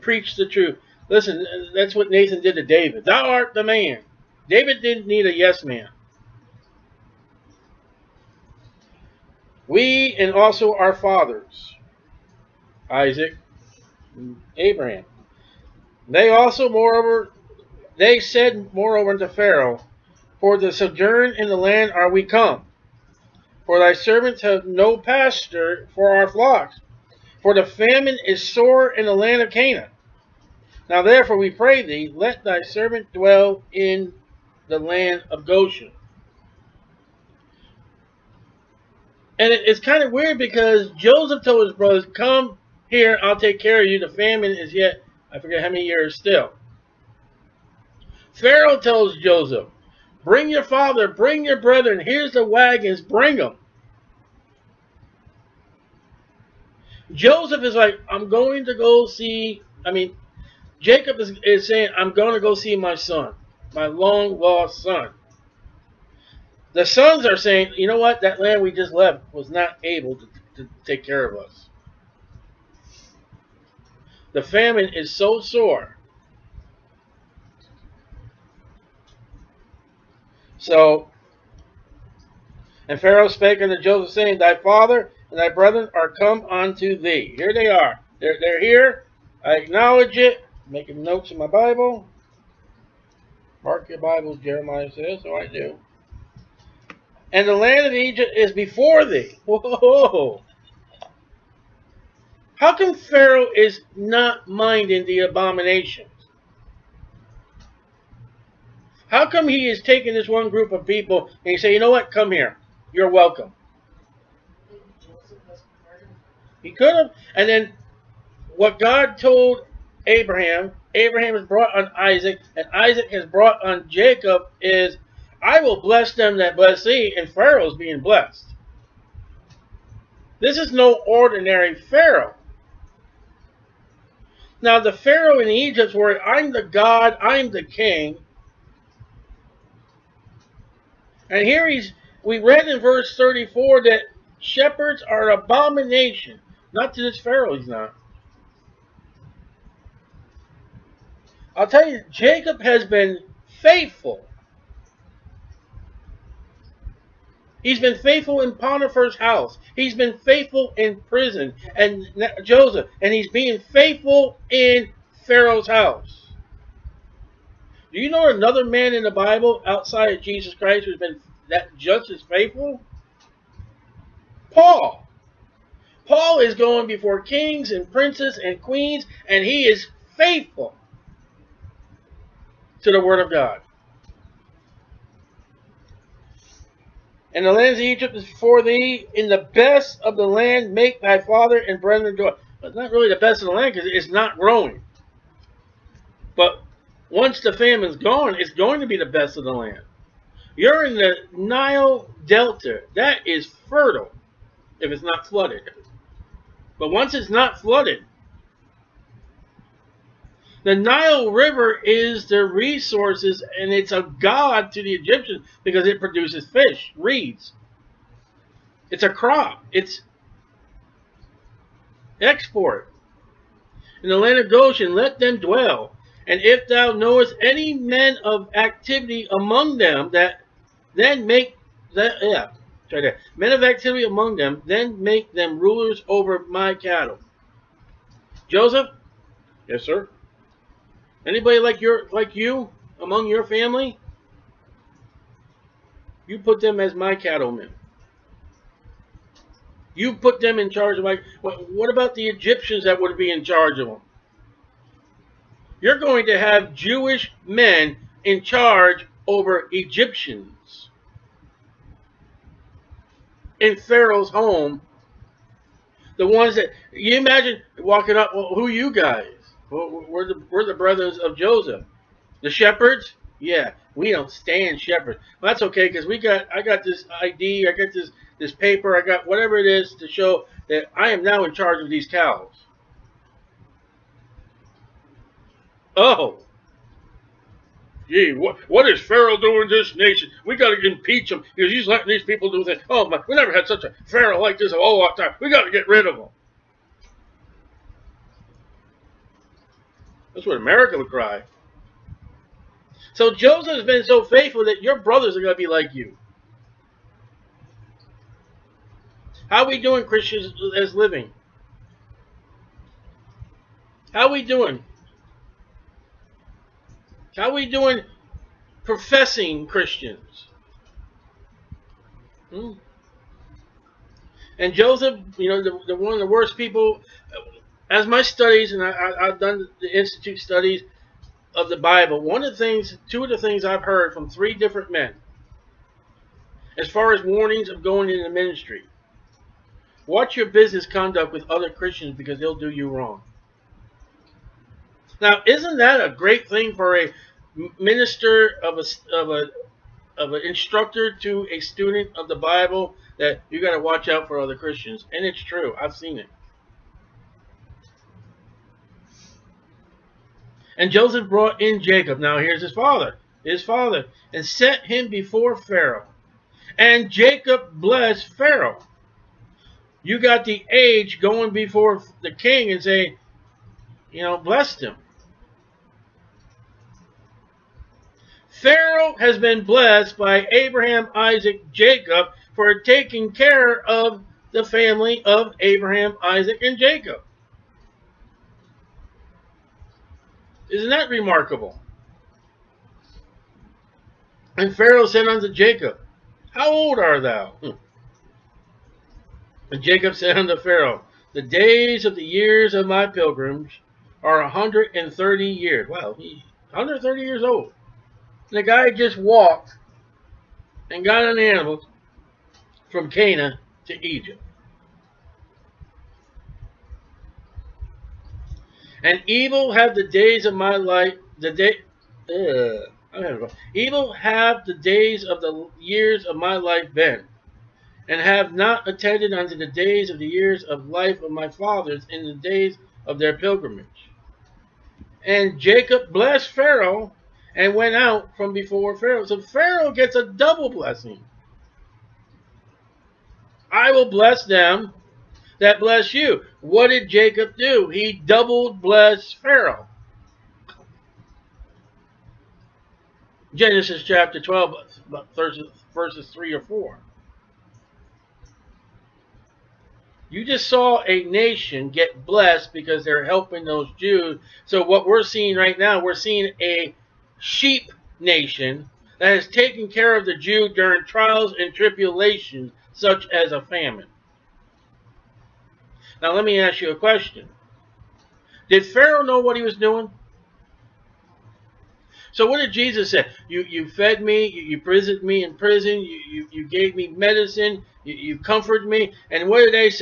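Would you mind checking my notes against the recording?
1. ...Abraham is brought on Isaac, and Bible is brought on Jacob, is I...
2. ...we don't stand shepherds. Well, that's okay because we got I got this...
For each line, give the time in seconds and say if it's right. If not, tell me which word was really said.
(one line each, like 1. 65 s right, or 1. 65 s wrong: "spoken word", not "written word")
1. 120 s wrong: "Isaac", not "Bible"
2. 273 s right.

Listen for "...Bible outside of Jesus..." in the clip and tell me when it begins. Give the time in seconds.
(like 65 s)
169 s.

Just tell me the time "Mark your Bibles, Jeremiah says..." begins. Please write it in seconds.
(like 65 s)
93 s.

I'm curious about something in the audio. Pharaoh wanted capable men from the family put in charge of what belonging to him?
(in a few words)
Cattle.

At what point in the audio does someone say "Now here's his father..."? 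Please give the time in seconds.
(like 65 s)
362 s.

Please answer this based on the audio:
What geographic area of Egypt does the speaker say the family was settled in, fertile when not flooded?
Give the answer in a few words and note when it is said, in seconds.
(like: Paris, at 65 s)
Nile Delta, at 201 s.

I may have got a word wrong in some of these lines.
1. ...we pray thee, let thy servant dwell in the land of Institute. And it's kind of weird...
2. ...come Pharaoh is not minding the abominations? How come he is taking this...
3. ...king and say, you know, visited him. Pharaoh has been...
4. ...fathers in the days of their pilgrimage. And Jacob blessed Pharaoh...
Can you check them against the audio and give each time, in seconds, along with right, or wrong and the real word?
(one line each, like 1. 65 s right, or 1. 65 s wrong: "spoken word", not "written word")
1. 31 s wrong: "Goshen", not "Institute"
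2. 102 s right
3. 372 s wrong: "blessed", not "visited"
4. 431 s right.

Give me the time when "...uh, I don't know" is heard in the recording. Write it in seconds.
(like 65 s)
422 s.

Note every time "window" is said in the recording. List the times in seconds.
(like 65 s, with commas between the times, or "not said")
not said.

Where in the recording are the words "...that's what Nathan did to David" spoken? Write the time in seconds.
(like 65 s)
1 s.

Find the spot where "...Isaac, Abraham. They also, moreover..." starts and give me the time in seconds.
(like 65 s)
12 s.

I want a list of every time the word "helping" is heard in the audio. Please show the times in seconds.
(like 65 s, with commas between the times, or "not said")
463 s.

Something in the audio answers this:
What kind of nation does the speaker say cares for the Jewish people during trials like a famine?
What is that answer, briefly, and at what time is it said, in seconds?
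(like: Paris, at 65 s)
Sheep nation, at 467 s.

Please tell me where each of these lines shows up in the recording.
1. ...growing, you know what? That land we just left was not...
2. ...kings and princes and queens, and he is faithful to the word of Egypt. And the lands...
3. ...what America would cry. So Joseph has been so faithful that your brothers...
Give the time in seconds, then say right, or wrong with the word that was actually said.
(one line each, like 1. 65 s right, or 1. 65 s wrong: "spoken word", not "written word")
1. 67 s wrong: "saying", not "growing"
2. 177 s wrong: "God", not "Egypt"
3. 300 s right.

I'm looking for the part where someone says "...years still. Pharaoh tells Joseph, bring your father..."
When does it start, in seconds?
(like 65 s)
45 s.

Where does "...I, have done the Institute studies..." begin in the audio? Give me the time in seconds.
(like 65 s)
328 s.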